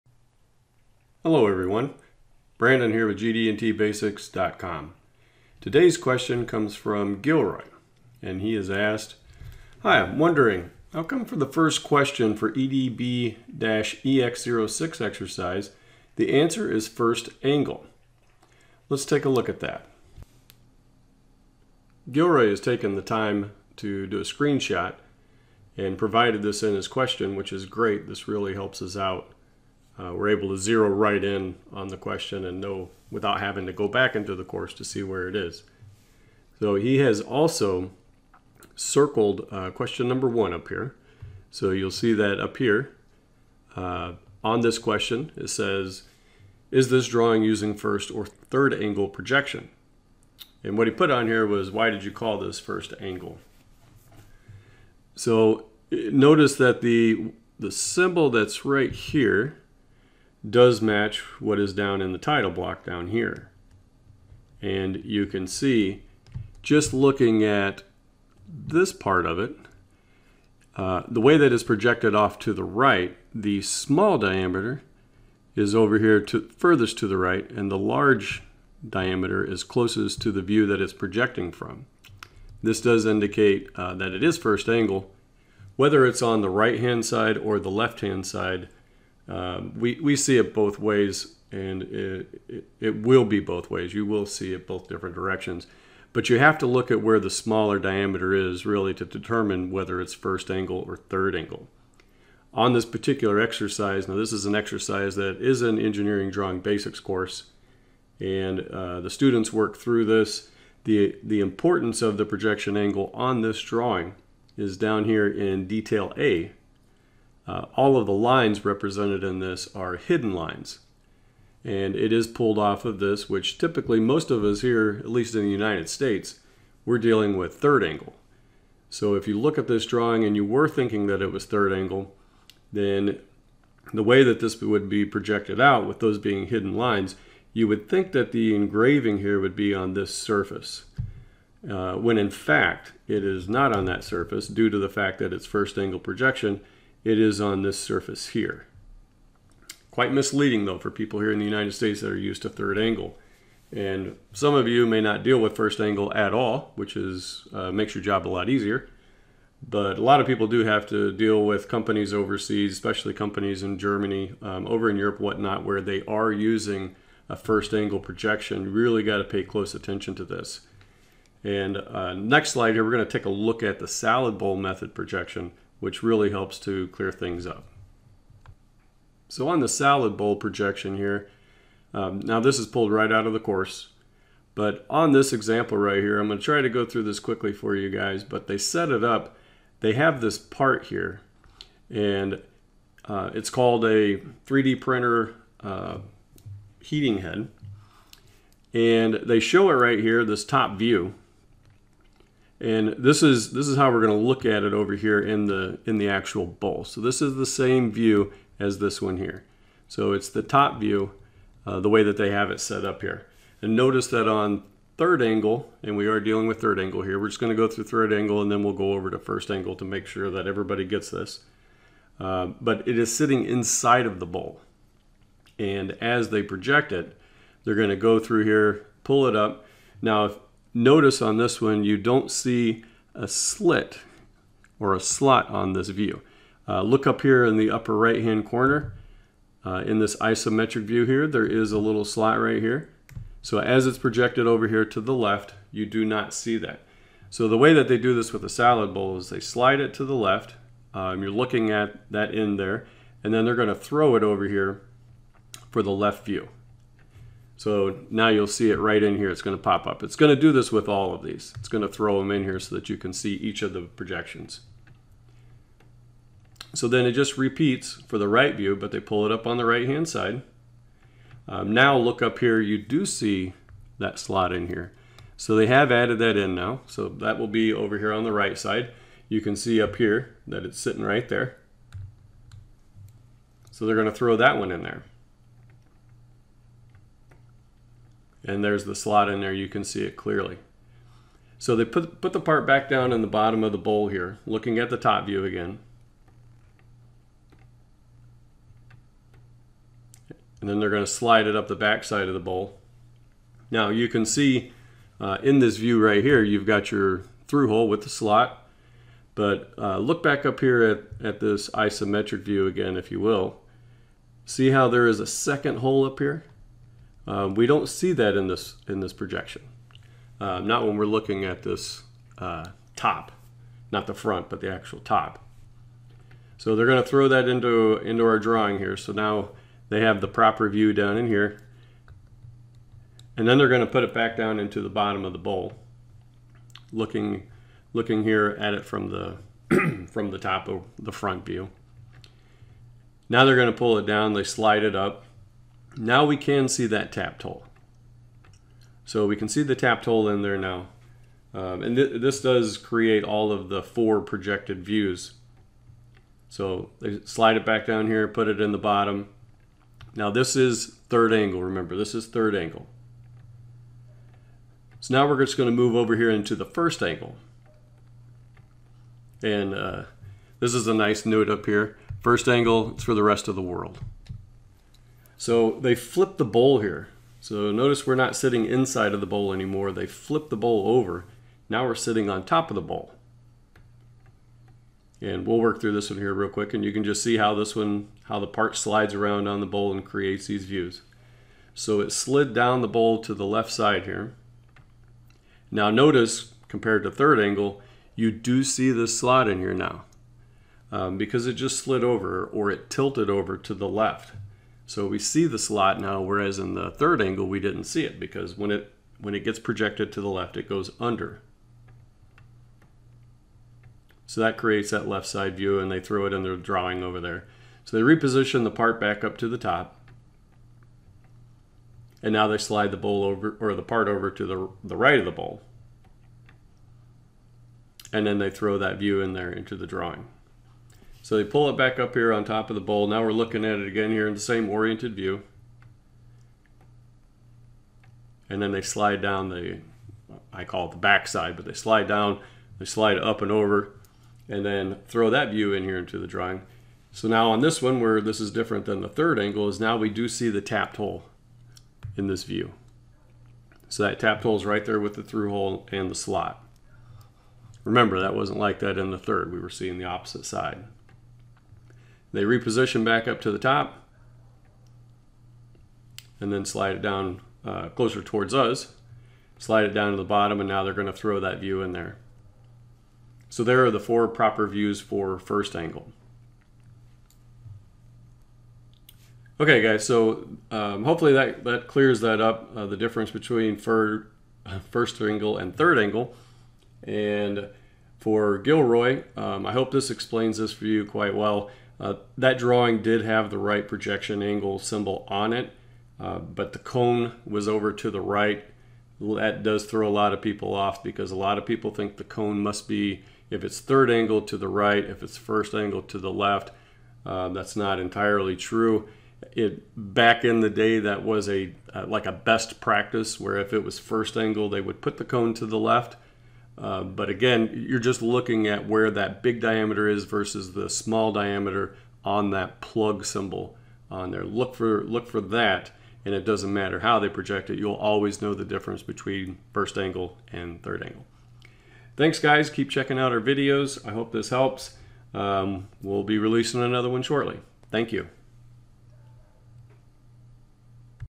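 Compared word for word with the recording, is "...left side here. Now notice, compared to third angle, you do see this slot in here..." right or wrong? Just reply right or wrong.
right.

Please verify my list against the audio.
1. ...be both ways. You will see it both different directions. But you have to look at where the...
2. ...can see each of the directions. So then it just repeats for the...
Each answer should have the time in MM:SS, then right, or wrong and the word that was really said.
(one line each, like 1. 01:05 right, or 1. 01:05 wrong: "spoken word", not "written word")
1. 01:33 right
2. 04:22 wrong: "projections", not "directions".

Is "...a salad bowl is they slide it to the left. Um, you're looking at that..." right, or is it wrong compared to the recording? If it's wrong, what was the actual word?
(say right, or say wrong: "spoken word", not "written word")
right.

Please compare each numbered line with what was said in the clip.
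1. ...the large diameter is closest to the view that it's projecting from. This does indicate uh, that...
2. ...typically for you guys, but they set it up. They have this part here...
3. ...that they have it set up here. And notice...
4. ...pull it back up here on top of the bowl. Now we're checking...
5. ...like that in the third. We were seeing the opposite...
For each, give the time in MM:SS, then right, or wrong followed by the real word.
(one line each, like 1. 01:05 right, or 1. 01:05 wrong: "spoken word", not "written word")
1. 01:17 right
2. 03:07 wrong: "quickly", not "typically"
3. 03:32 right
4. 07:11 wrong: "looking", not "checking"
5. 07:38 right.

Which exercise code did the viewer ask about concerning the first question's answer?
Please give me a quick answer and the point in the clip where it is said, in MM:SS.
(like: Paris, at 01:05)
EDB-EX06, at 00:12.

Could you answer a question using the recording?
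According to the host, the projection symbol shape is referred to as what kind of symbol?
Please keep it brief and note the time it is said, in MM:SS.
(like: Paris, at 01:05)
Plug symbol, at 08:42.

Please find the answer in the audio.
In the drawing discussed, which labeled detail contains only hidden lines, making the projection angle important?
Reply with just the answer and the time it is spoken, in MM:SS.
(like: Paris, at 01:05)
Detail A, at 01:55.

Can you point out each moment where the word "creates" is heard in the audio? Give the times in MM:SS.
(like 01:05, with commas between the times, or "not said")
05:52, 06:30, 06:54.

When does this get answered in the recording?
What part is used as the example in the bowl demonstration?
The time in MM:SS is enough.
03:14.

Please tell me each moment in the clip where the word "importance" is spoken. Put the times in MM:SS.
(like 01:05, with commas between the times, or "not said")
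01:51.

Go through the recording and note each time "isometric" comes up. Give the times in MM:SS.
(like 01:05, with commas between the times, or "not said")
04:00, 05:11.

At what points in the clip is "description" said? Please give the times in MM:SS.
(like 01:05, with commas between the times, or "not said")
not said.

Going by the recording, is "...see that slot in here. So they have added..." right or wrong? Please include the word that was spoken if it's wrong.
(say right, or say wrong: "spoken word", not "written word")
right.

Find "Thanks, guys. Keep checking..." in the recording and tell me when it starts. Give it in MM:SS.
08:52.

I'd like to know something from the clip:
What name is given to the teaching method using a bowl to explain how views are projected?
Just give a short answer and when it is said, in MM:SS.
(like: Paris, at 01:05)
Salad bowl method, at 02:53.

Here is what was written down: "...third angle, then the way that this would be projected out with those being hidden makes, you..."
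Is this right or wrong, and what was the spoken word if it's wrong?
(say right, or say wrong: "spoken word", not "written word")
wrong: "lines", not "makes".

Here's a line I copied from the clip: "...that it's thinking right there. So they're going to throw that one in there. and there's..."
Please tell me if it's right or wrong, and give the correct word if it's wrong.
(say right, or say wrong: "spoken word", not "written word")
wrong: "sitting", not "thinking".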